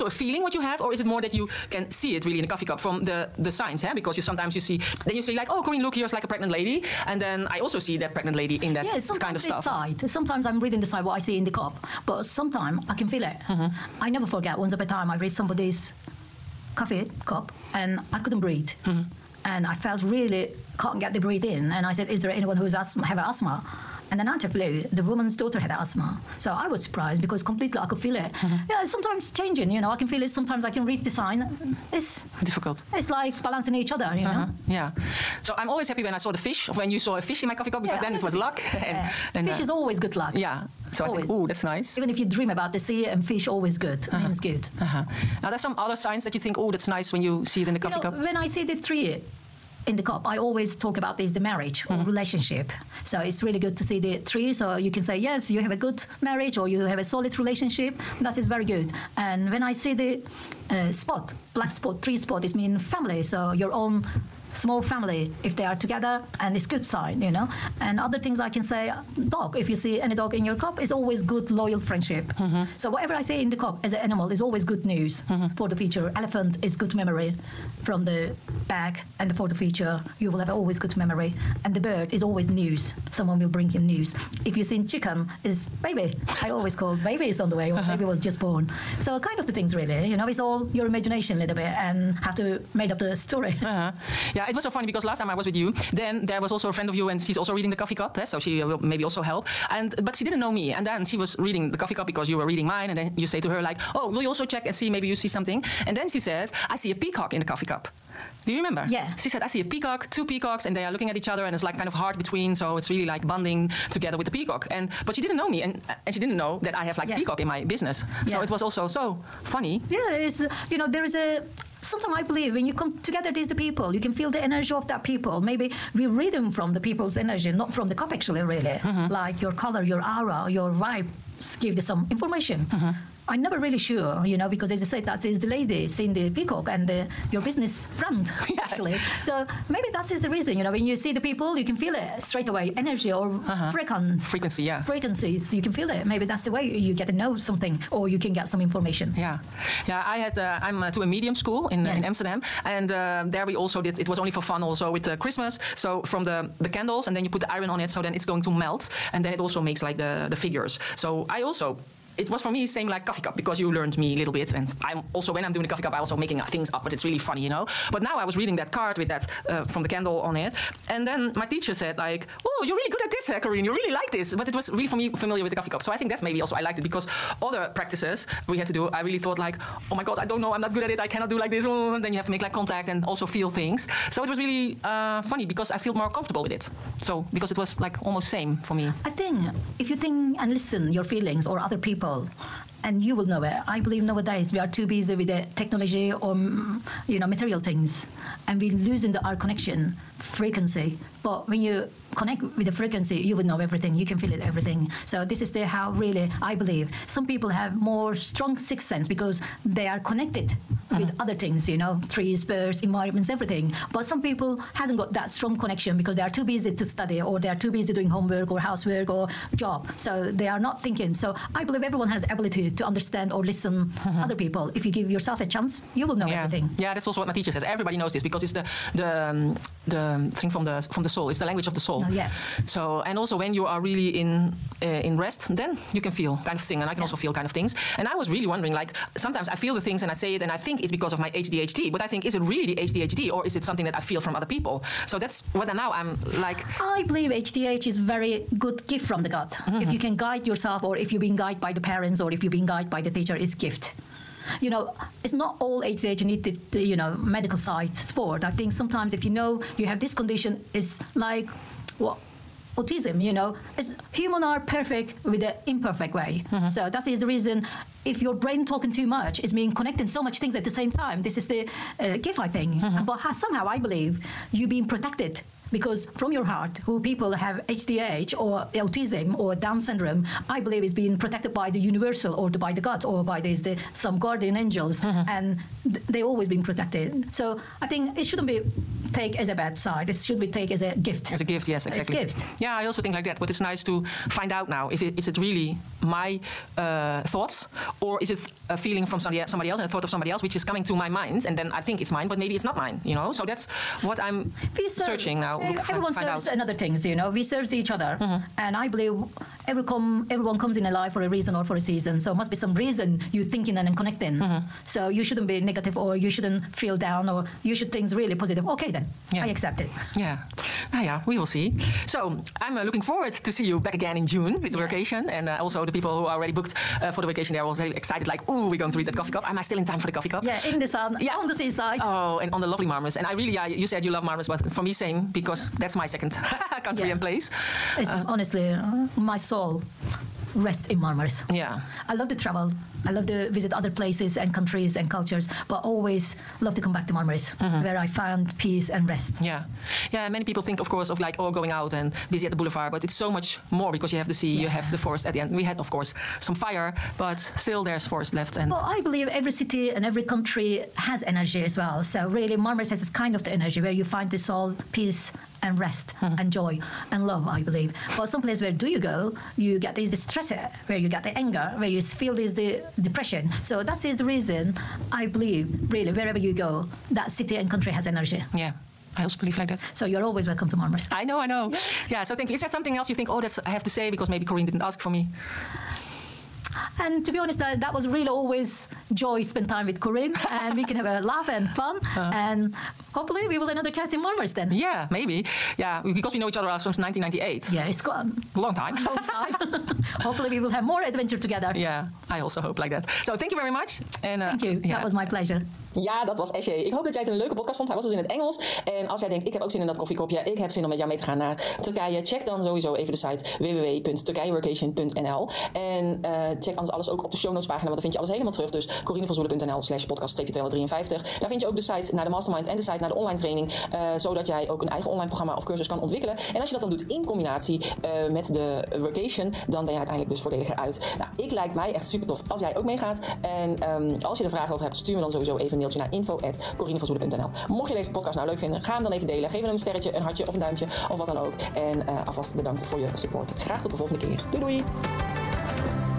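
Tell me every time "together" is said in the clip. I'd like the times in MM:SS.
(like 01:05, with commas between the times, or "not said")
01:05, 01:53, 02:03, 06:41.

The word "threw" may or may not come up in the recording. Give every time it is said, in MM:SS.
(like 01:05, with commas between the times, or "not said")
not said.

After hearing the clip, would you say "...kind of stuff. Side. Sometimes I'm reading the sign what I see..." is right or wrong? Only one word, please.
right.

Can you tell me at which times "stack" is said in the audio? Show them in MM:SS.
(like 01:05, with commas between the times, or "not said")
not said.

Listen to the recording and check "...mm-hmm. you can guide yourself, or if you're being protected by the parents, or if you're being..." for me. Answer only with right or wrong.
wrong.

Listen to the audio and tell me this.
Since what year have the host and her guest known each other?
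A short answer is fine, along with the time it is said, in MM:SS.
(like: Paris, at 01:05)
1998, at 06:36.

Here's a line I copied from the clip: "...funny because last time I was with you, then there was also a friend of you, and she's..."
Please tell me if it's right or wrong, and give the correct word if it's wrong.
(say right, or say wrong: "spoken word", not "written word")
right.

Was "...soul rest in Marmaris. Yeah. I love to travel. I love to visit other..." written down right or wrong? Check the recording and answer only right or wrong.
right.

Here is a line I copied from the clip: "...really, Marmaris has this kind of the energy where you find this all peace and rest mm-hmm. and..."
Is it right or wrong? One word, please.
right.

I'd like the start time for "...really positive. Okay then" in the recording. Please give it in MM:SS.
05:18.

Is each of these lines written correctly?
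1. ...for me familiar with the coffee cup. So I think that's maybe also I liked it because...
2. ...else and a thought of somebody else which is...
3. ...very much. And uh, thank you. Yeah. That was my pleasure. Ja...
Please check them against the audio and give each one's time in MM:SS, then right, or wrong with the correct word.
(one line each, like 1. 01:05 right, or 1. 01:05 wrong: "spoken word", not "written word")
1. 02:54 right
2. 04:59 right
3. 06:43 right.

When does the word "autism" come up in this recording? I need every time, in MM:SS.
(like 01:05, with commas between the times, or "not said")
04:22, 04:38.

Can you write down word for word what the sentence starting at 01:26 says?
I always called baby is on the way, or uh-huh.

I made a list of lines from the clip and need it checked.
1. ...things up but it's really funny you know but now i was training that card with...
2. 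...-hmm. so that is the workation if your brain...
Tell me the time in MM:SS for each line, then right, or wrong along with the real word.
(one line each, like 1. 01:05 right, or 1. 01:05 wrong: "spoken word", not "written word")
1. 02:46 wrong: "reading", not "training"
2. 04:26 wrong: "reason", not "workation".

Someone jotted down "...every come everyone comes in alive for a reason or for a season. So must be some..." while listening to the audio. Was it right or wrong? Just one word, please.
right.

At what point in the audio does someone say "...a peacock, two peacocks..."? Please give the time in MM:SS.
01:49.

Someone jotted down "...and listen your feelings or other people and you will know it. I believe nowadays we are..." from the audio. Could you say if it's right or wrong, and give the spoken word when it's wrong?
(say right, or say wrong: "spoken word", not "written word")
right.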